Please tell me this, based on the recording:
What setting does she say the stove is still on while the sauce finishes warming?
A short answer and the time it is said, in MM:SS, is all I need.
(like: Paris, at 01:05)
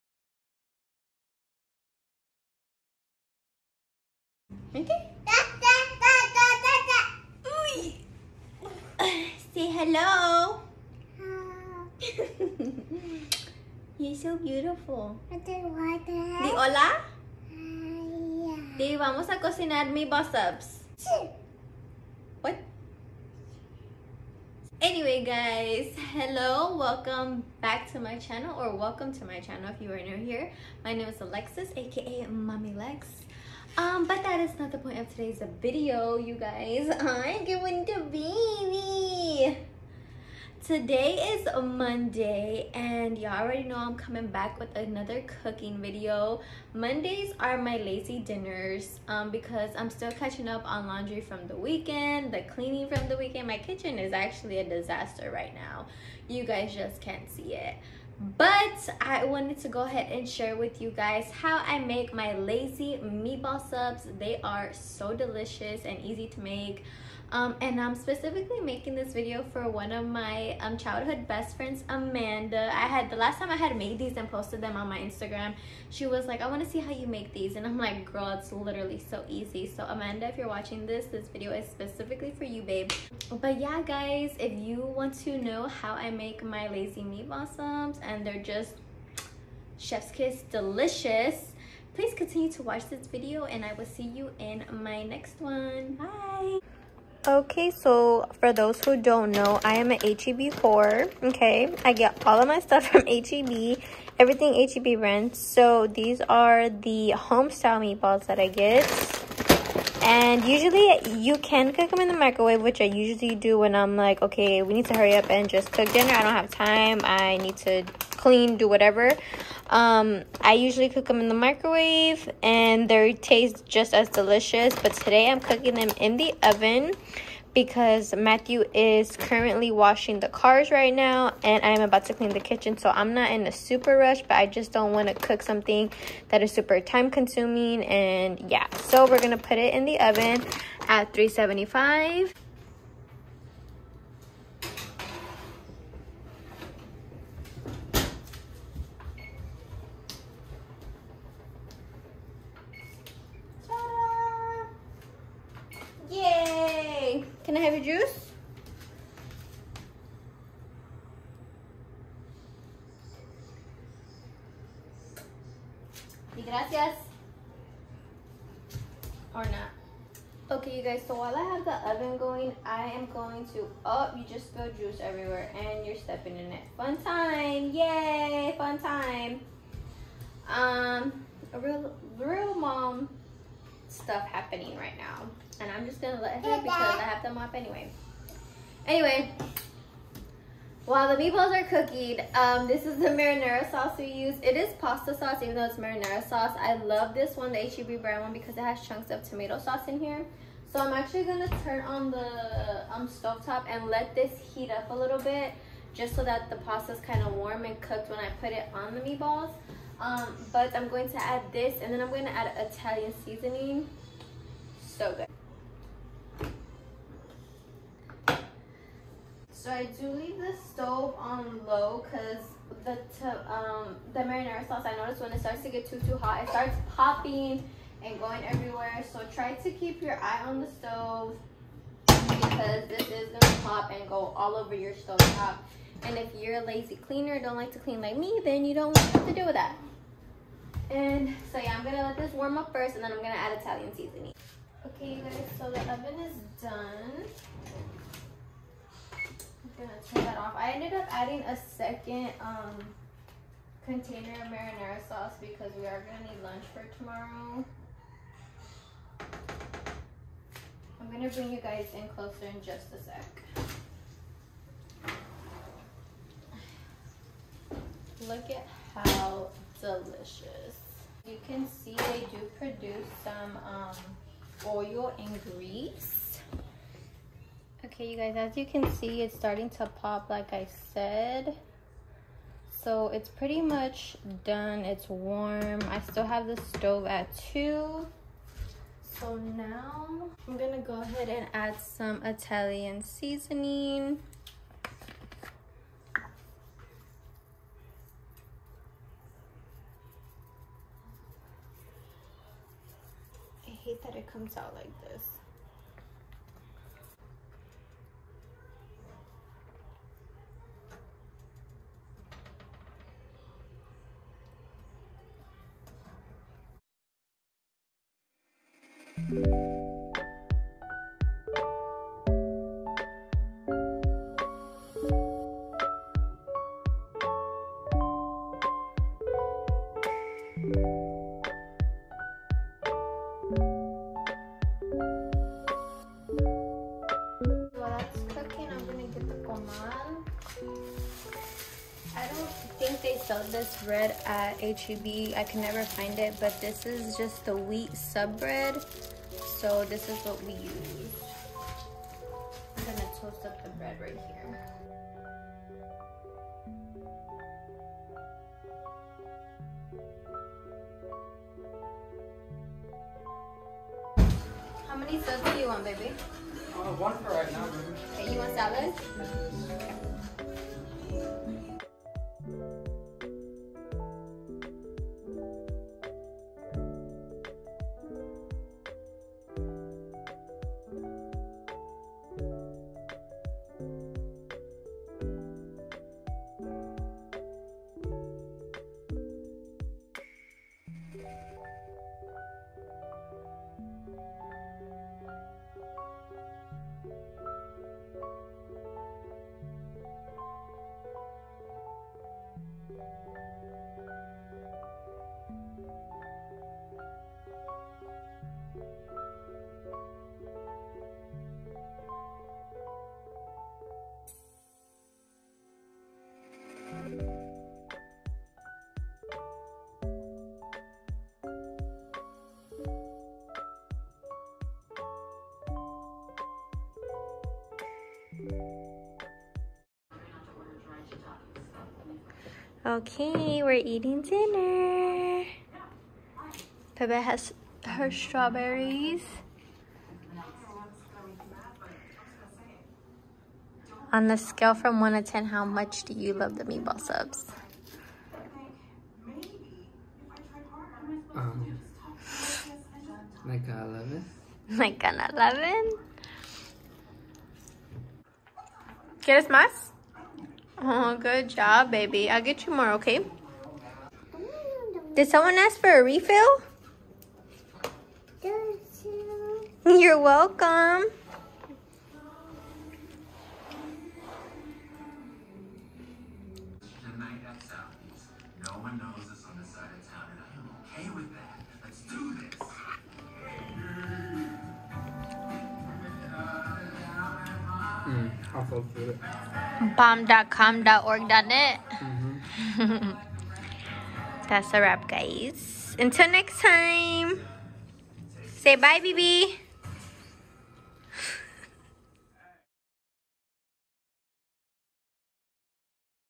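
2, at 04:47.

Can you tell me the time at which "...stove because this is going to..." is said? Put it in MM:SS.
03:50.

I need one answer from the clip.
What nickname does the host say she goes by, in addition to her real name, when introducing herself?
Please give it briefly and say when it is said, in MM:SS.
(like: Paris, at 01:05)
Mami Lexx, at 00:32.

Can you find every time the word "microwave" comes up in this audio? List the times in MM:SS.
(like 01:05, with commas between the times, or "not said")
01:52, 02:01.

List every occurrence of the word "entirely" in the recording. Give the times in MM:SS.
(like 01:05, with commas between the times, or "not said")
not said.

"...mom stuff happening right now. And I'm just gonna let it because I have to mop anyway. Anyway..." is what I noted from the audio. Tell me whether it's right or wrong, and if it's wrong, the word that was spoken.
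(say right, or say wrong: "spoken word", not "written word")
right.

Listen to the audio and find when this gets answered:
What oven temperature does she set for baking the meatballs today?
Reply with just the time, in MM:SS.
02:21.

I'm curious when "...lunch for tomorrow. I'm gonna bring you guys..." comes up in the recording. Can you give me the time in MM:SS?
04:16.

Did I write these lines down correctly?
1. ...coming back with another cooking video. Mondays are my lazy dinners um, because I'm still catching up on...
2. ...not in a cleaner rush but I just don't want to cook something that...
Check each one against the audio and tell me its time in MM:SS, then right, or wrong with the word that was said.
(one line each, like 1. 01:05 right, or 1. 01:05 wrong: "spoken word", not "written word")
1. 00:43 right
2. 02:13 wrong: "super", not "cleaner".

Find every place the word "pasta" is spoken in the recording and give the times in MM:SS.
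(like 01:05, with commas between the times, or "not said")
03:14, 03:26.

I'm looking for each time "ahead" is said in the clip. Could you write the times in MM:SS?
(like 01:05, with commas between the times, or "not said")
00:59, 04:51.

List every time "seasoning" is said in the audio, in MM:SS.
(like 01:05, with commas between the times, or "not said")
03:33, 04:03, 04:53.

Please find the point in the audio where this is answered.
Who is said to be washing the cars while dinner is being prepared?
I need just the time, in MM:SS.
02:08.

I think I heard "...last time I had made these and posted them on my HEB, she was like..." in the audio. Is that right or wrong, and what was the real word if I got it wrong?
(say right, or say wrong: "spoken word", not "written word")
wrong: "Instagram", not "HEB".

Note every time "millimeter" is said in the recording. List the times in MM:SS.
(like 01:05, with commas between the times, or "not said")
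not said.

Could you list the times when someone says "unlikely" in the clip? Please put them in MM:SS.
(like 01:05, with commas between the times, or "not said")
not said.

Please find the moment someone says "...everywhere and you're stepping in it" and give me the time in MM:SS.
02:54.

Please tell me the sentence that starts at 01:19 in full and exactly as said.
So Amanda, if you're watching this, this video is specifically for you, babe.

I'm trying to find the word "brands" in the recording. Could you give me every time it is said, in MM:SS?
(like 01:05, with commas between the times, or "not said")
01:44, 03:18.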